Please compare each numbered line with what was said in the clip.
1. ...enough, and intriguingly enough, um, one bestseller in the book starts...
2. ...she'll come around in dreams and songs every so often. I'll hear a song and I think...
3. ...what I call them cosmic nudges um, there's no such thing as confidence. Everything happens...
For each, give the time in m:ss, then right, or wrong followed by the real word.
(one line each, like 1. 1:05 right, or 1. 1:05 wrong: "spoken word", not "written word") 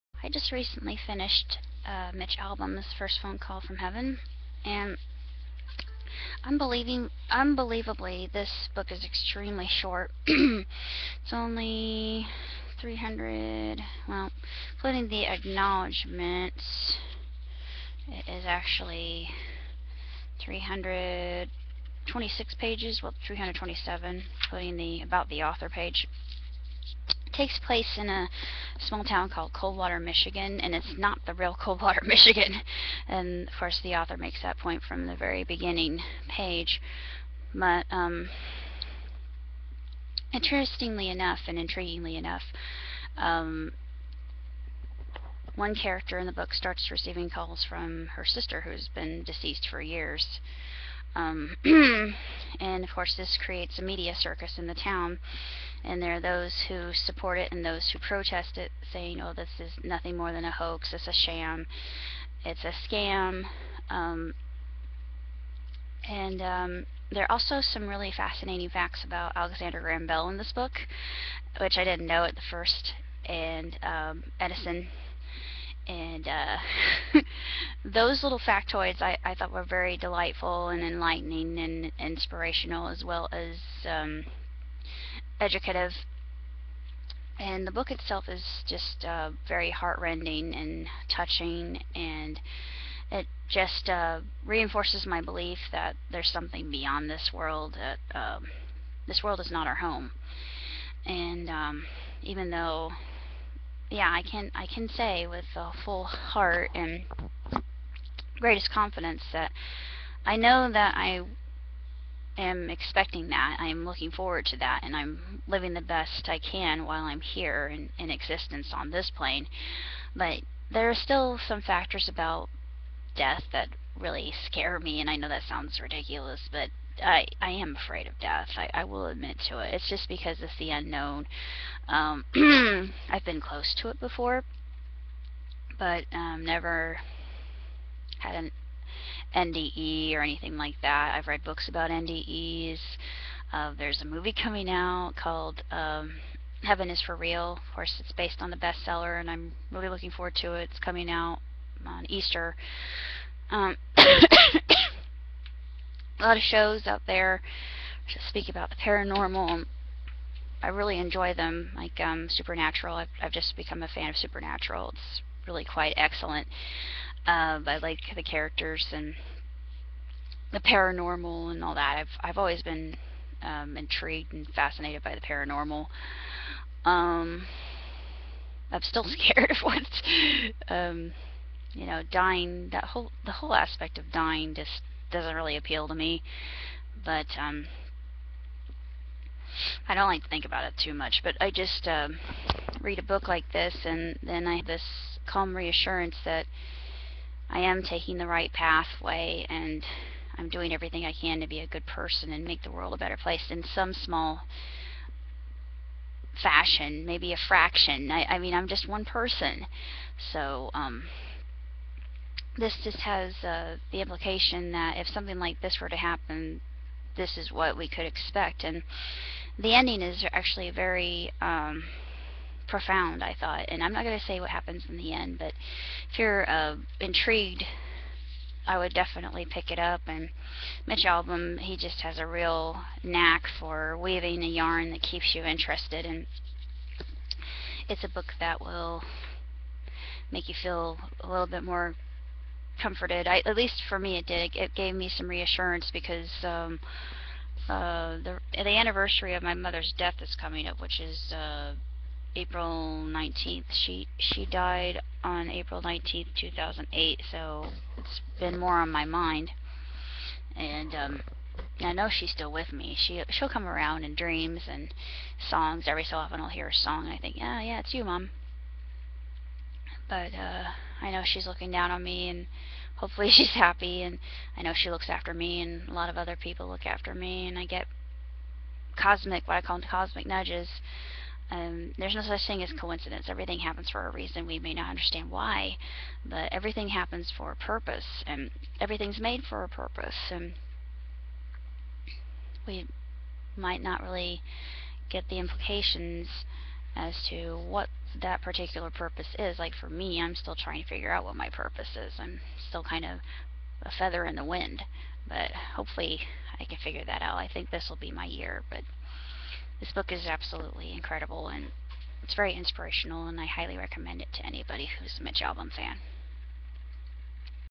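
1. 0:41 wrong: "character", not "bestseller"
2. 4:23 right
3. 4:39 wrong: "coincidence", not "confidence".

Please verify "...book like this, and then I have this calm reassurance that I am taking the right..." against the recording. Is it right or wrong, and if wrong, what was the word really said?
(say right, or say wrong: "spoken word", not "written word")
right.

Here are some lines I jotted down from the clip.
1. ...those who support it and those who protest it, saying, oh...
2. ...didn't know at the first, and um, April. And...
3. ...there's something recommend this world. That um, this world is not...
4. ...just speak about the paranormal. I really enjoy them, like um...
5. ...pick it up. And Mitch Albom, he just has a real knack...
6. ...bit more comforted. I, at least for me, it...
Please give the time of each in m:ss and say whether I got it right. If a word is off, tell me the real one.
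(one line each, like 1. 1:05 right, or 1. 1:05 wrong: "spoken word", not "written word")
1. 0:56 right
2. 1:11 wrong: "Edison", not "April"
3. 1:36 wrong: "beyond", not "recommend"
4. 2:38 right
5. 3:49 right
6. 4:01 right.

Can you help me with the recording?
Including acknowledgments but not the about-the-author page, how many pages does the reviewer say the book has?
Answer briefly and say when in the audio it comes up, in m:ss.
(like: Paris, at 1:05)
326, at 0:20.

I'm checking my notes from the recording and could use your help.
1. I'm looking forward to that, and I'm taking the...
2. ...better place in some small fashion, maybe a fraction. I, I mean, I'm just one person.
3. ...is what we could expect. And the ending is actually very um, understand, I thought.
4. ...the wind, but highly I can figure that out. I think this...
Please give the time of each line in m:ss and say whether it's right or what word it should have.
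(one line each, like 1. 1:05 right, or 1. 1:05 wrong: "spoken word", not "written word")
1. 1:53 wrong: "living", not "taking"
2. 3:22 right
3. 3:37 wrong: "profound", not "understand"
4. 5:04 wrong: "hopefully", not "highly".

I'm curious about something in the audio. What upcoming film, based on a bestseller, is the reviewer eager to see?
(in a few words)
Heaven is for Real.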